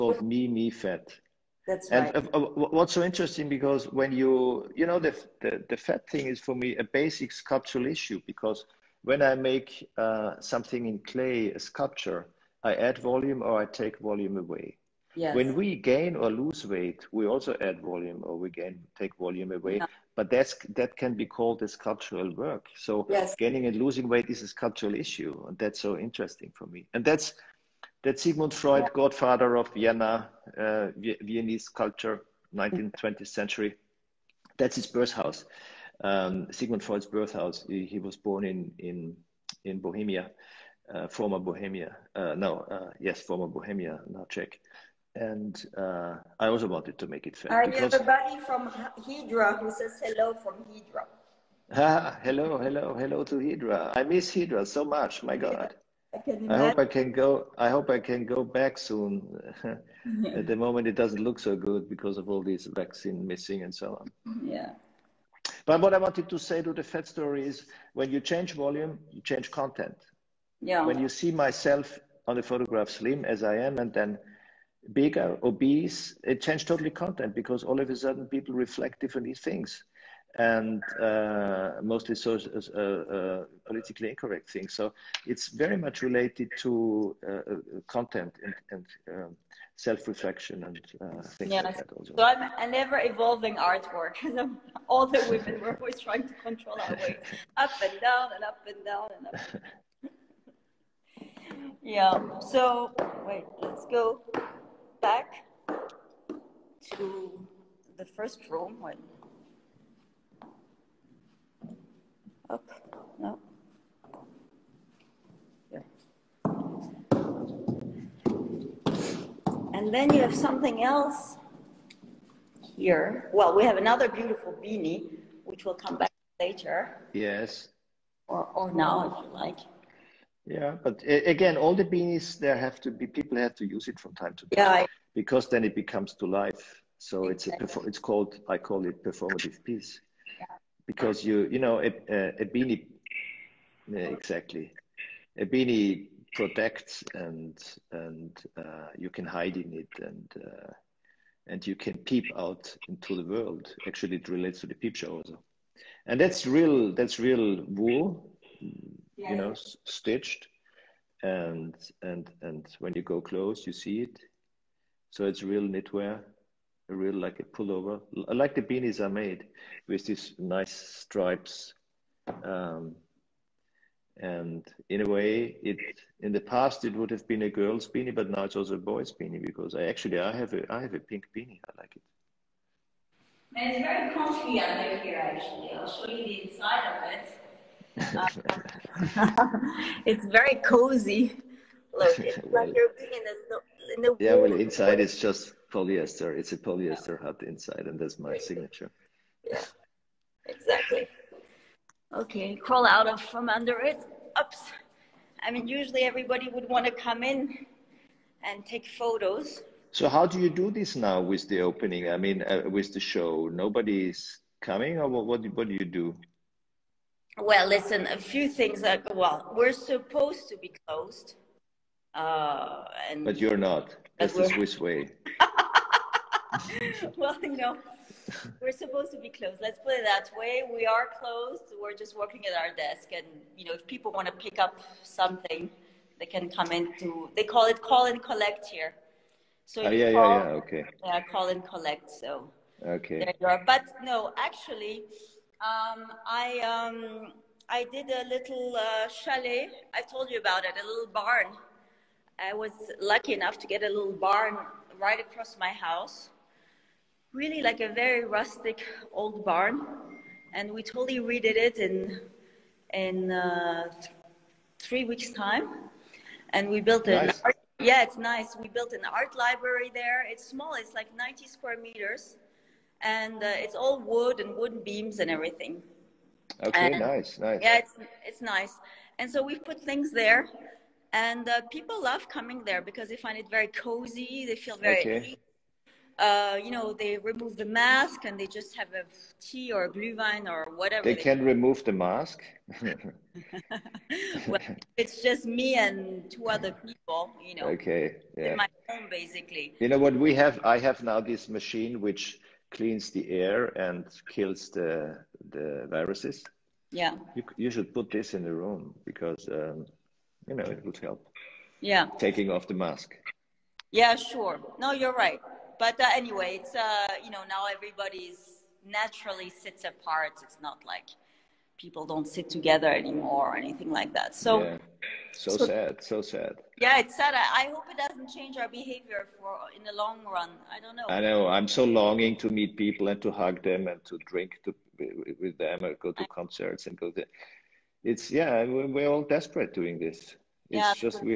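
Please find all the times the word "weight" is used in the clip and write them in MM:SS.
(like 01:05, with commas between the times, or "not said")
00:16, 00:24, 01:36.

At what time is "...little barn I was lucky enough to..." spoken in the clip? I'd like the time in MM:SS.
04:10.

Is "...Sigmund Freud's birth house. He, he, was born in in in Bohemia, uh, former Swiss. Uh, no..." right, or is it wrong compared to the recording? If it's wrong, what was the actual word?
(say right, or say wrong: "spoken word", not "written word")
wrong: "Bohemia", not "Swiss".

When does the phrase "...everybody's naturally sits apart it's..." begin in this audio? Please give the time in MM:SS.
05:17.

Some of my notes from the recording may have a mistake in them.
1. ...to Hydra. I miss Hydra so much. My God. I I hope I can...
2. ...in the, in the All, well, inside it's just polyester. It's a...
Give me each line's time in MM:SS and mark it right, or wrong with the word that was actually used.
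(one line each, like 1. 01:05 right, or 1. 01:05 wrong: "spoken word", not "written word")
1. 00:53 right
2. 03:13 wrong: "Yeah", not "All".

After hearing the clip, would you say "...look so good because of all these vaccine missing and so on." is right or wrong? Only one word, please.
right.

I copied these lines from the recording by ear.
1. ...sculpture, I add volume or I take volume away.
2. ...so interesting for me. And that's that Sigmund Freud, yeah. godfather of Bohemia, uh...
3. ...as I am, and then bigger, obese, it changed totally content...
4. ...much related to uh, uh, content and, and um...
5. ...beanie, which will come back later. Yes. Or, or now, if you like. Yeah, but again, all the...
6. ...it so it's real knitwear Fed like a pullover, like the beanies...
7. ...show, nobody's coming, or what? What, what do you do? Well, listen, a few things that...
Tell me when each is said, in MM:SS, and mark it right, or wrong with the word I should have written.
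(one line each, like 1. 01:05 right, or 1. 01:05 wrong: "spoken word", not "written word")
1. 00:11 right
2. 00:25 wrong: "Vienna", not "Bohemia"
3. 01:13 right
4. 01:25 right
5. 02:04 right
6. 02:44 wrong: "Really", not "Fed"
7. 03:33 right.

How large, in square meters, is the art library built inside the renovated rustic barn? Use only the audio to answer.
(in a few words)
90 square meters.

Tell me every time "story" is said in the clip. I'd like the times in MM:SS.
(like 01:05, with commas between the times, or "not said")
01:07.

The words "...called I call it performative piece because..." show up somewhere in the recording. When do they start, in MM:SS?
02:17.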